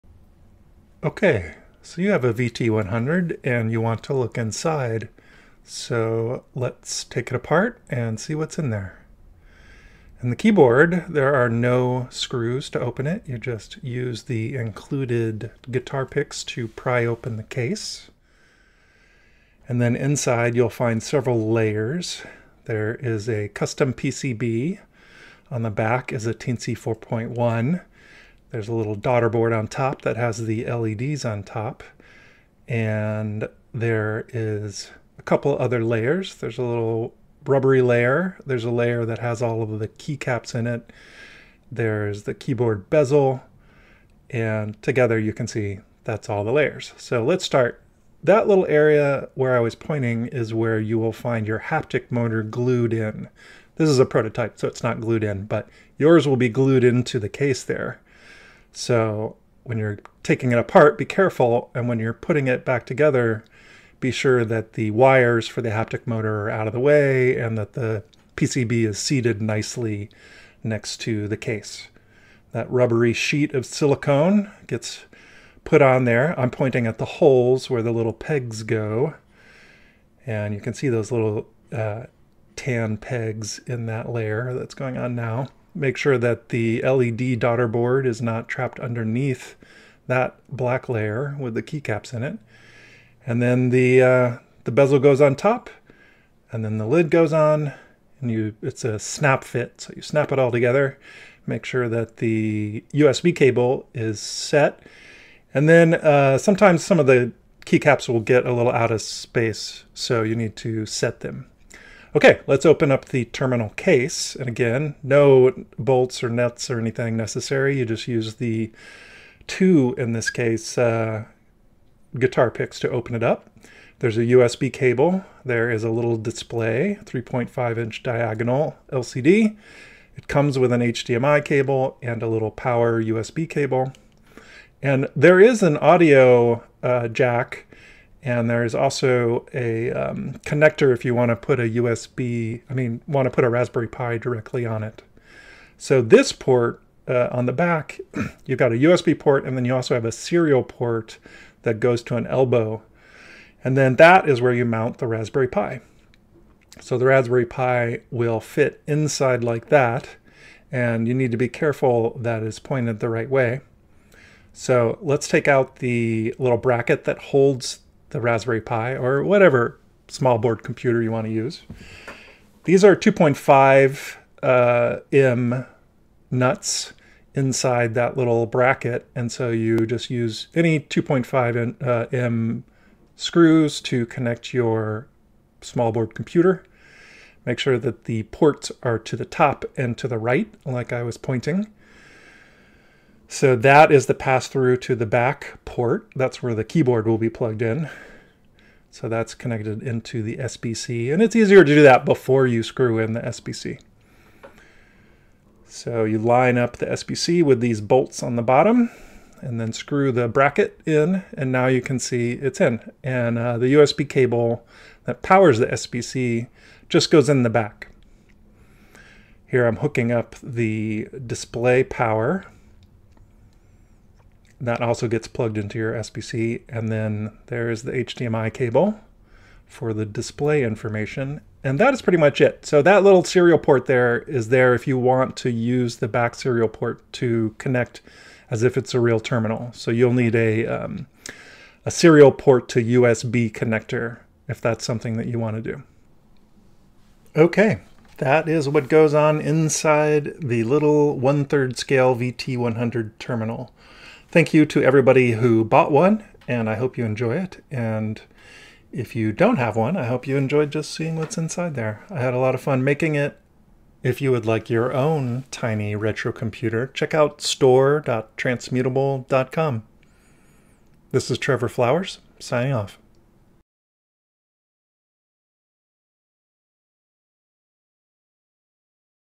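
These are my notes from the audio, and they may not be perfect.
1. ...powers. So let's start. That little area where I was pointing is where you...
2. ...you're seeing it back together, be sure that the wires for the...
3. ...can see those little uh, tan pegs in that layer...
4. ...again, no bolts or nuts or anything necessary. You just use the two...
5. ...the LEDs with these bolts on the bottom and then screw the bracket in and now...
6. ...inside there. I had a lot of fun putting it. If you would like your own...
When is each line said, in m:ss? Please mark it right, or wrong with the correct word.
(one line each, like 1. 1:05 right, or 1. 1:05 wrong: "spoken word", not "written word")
1. 0:46 wrong: "layers", not "powers"
2. 1:01 wrong: "putting", not "seeing"
3. 1:20 right
4. 1:54 right
5. 3:26 wrong: "SBC", not "LEDs"
6. 4:21 wrong: "making", not "putting".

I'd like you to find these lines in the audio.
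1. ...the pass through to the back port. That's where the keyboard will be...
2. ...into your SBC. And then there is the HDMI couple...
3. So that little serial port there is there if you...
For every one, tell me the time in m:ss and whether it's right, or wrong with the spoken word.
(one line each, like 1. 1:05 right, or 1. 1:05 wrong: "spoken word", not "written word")
1. 3:14 right
2. 3:45 wrong: "cable", not "couple"
3. 3:52 right.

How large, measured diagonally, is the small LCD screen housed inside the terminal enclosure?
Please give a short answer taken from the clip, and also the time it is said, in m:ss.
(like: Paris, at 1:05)
3.5 inch, at 2:07.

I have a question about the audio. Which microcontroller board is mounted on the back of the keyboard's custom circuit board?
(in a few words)
Teensy 4.1.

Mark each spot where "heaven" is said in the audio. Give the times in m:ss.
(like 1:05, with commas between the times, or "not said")
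not said.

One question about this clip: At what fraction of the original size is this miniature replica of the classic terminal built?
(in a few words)
One-third scale.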